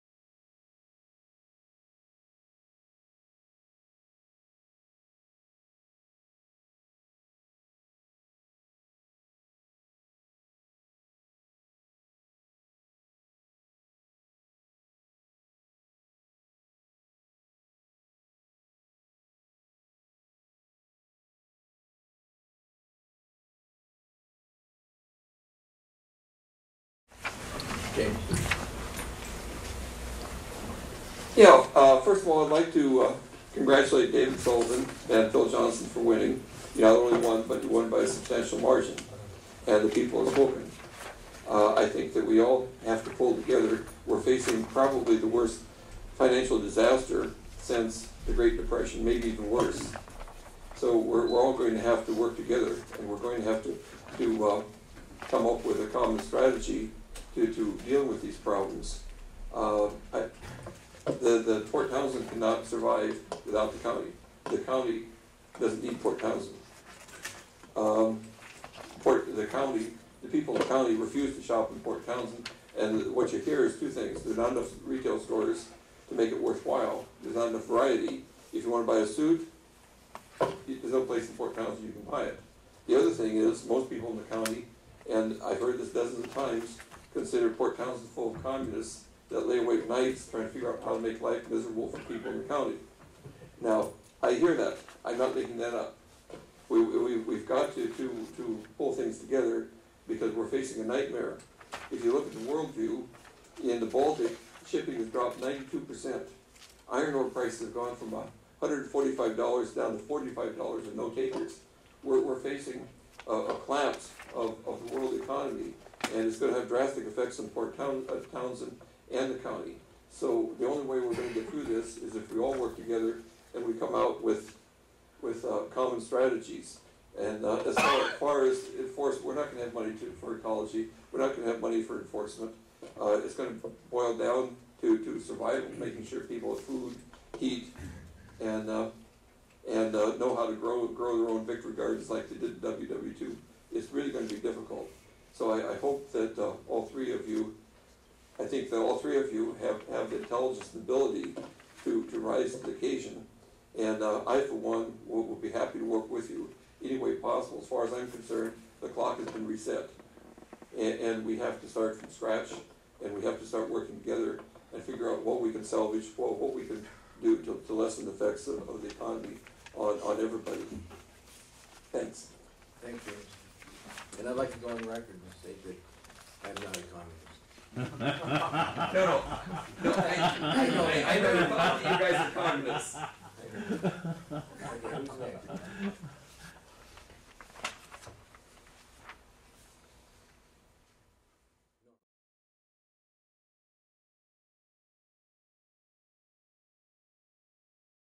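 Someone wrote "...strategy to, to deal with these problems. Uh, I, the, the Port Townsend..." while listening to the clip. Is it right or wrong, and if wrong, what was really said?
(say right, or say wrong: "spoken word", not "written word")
right.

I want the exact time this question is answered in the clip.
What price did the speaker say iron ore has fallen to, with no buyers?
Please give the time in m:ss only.
1:50.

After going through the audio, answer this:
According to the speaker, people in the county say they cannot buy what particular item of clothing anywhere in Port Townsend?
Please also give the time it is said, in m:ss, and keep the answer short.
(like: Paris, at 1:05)
A suit, at 1:19.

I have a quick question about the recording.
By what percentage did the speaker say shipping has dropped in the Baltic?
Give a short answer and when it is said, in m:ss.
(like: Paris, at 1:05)
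92%, at 1:45.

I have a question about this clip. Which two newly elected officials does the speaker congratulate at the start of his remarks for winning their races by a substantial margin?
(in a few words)
David Sullivan and Phil Johnson.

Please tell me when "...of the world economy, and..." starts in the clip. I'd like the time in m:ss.
1:54.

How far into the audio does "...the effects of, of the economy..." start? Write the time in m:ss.
2:48.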